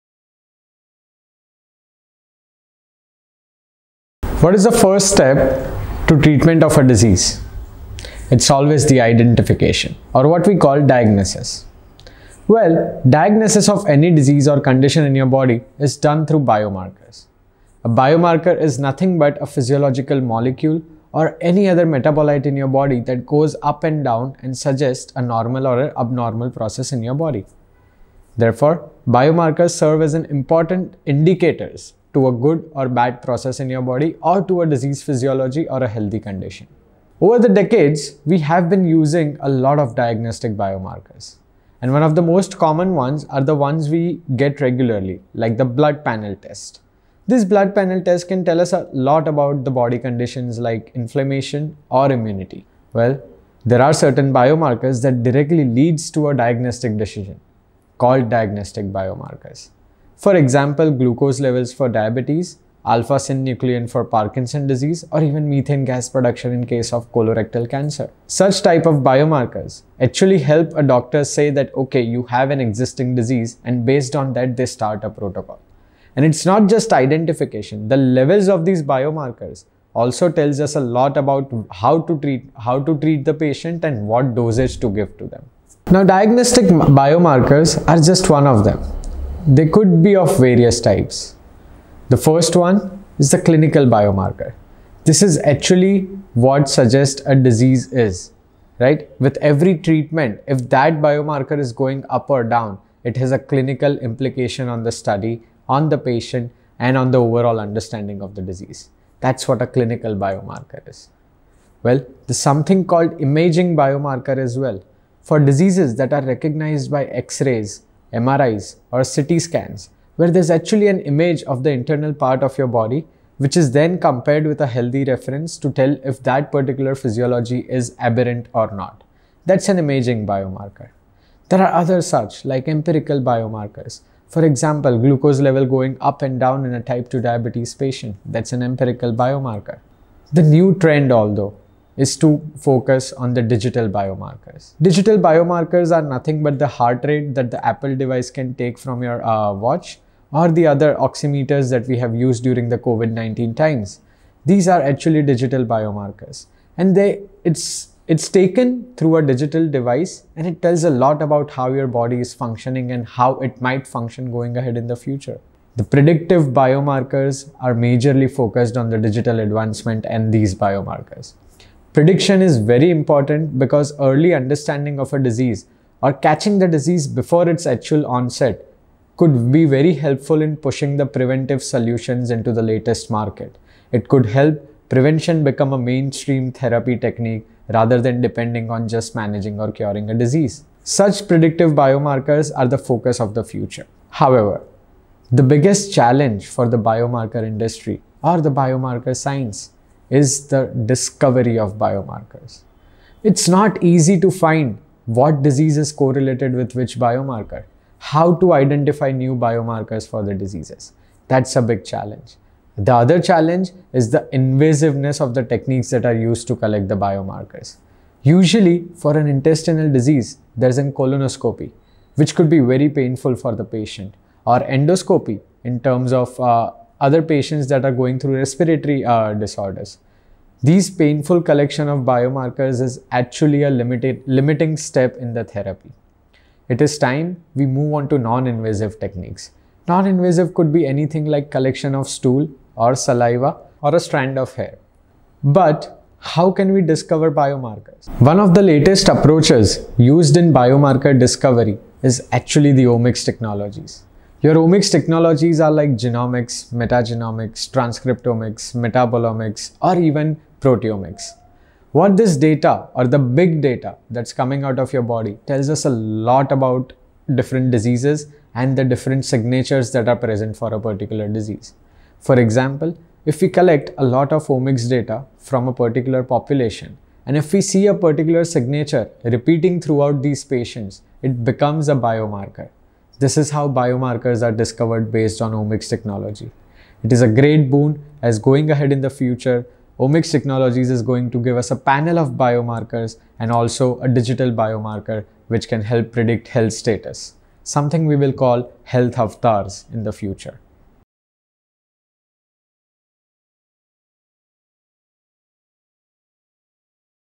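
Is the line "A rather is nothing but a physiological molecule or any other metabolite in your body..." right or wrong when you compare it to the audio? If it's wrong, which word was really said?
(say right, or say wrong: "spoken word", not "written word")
wrong: "biomarker", not "rather".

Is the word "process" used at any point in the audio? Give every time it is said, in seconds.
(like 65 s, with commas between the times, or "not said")
26 s, 33 s.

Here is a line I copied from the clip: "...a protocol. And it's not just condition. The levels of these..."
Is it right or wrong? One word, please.
wrong.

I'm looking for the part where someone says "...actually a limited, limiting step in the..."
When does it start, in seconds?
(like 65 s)
233 s.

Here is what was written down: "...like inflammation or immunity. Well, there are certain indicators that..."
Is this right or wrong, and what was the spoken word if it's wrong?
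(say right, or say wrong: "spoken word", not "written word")
wrong: "biomarkers", not "indicators".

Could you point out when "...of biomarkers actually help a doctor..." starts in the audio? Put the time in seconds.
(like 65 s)
68 s.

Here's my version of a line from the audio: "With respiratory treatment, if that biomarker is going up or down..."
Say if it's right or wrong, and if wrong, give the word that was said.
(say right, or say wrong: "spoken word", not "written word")
wrong: "every", not "respiratory".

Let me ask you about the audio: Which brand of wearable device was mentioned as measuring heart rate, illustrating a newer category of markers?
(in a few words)
Apple.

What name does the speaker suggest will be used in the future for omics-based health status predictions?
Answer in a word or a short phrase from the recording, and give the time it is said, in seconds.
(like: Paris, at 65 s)
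health avatars, at 298 s.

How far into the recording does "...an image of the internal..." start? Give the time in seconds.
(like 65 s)
120 s.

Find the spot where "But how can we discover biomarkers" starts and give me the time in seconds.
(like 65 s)
245 s.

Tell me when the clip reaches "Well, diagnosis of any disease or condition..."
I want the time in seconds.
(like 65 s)
12 s.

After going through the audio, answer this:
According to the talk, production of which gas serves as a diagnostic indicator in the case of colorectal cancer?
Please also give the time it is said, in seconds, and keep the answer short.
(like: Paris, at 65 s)
methane, at 65 s.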